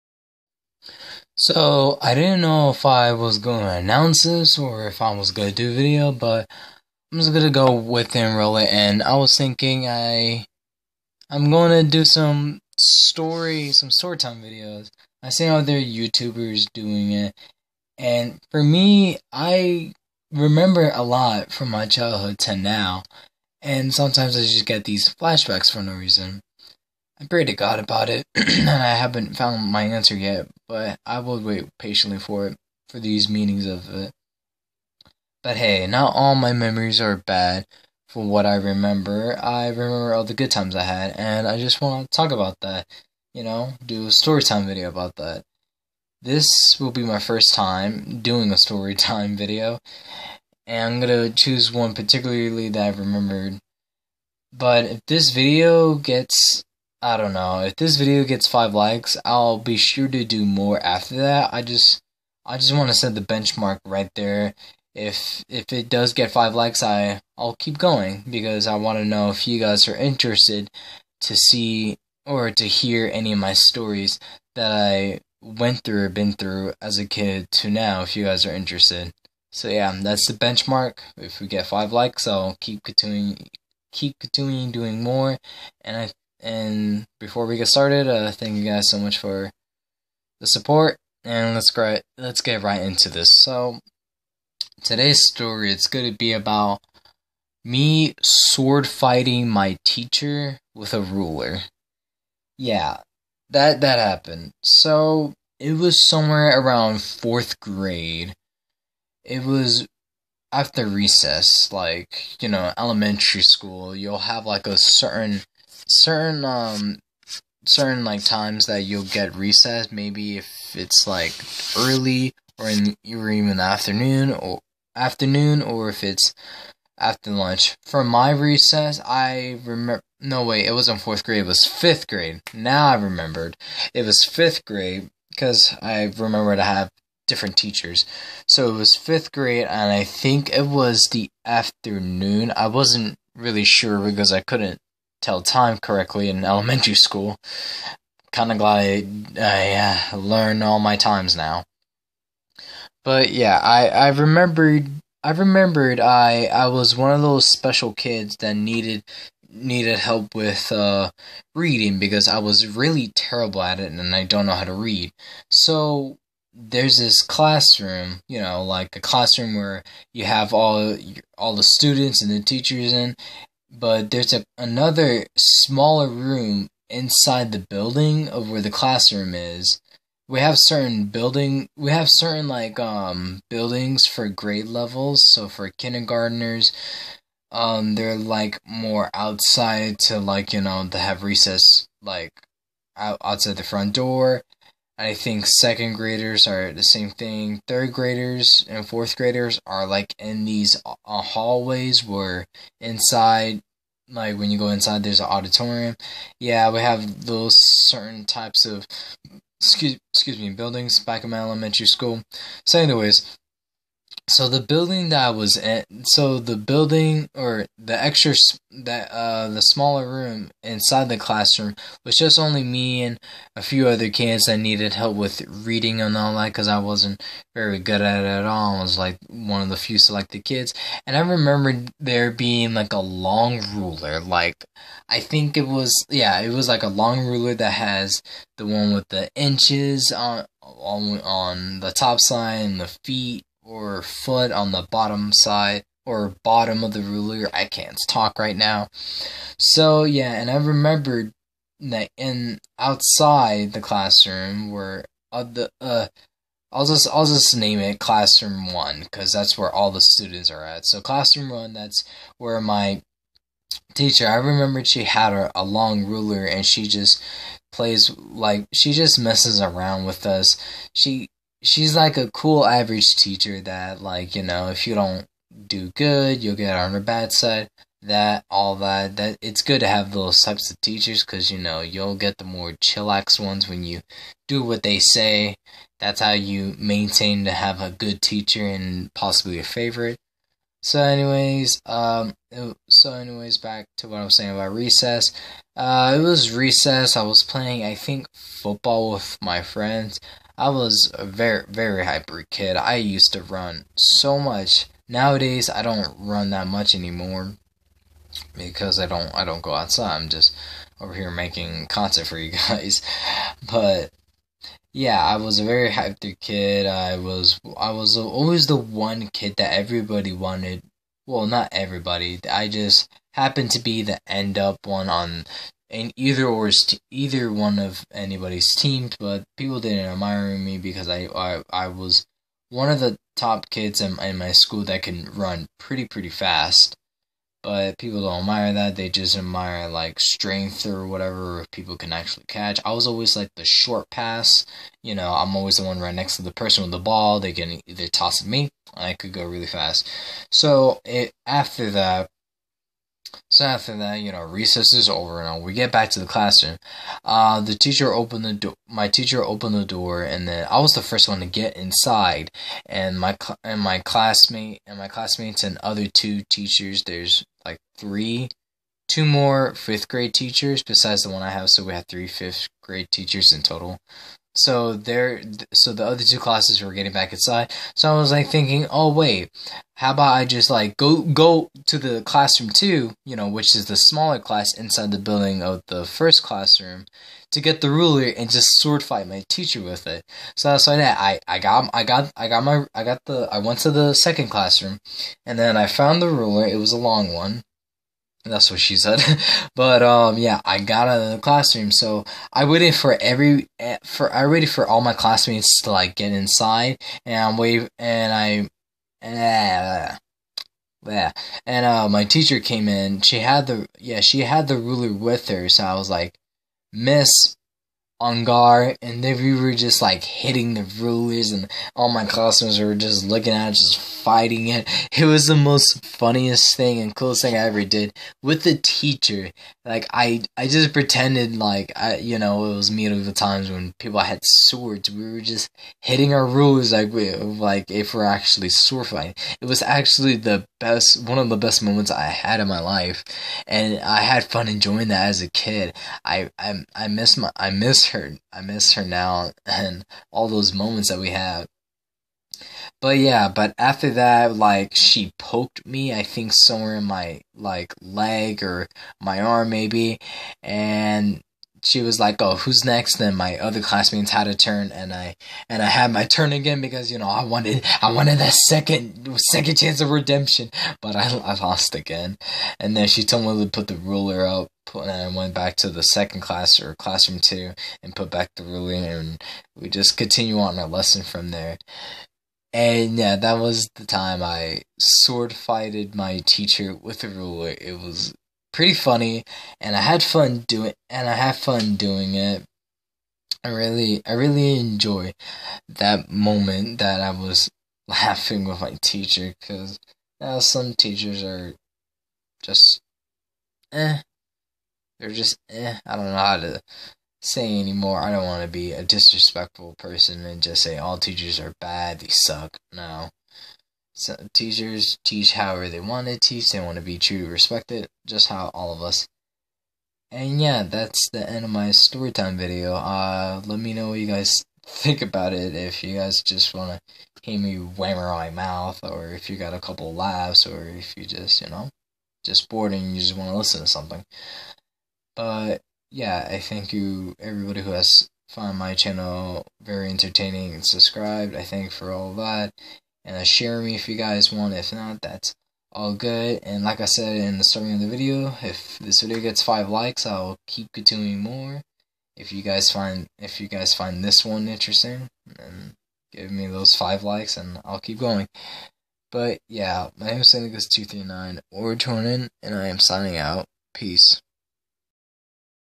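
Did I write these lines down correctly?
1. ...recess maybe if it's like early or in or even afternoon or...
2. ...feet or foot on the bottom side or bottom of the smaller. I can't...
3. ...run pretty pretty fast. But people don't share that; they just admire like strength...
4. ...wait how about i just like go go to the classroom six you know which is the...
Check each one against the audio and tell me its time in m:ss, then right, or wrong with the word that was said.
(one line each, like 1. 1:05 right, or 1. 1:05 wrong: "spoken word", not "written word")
1. 1:59 right
2. 4:03 wrong: "ruler", not "smaller"
3. 5:35 wrong: "admire", not "share"
4. 6:19 wrong: "two", not "six".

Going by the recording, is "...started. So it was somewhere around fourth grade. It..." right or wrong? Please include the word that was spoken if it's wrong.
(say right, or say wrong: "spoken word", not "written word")
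wrong: "happened", not "started".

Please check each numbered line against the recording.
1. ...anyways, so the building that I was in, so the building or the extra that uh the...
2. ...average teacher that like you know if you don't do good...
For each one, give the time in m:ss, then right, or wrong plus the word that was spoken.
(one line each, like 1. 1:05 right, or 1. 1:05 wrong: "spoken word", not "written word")
1. 3:32 right
2. 4:32 right.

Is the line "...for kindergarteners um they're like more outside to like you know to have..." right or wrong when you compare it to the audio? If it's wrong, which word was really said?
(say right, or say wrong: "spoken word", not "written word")
right.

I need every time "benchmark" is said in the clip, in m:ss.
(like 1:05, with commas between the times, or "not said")
1:03, 1:20.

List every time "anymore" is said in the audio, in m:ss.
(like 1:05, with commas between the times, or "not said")
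5:06, 8:27.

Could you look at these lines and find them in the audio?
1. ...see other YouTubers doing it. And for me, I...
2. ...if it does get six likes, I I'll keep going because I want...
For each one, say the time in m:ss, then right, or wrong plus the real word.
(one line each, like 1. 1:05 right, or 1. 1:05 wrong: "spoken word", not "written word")
1. 0:15 right
2. 1:05 wrong: "five", not "six".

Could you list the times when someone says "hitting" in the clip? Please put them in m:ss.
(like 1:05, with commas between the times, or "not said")
7:00, 7:16.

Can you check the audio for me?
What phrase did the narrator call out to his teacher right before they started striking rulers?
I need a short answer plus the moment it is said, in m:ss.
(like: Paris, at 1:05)
On guard, at 6:58.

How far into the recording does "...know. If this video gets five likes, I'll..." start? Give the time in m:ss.
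0:57.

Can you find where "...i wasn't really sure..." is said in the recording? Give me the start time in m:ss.
2:22.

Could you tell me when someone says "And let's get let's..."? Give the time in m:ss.
1:31.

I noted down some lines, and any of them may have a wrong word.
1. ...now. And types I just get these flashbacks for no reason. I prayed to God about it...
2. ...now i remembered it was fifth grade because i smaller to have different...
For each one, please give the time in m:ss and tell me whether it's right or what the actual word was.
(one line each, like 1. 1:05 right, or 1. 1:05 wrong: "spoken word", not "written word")
1. 0:22 wrong: "sometimes", not "types"
2. 2:12 wrong: "remember", not "smaller".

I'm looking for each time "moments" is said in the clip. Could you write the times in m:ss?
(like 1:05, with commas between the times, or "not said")
7:21, 7:30, 8:16.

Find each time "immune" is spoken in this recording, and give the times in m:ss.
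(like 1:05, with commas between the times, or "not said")
not said.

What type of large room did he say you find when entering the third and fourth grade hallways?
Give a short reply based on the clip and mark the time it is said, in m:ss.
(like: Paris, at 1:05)
An auditorium, at 3:25.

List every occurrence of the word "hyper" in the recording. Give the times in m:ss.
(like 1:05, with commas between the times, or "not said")
5:02, 5:15.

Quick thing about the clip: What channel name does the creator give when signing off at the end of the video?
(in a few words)
Syndicus239.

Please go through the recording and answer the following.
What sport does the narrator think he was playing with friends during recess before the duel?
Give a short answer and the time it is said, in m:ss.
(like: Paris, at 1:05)
Football, at 4:58.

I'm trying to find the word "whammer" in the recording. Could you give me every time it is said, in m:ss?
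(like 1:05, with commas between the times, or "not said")
8:47.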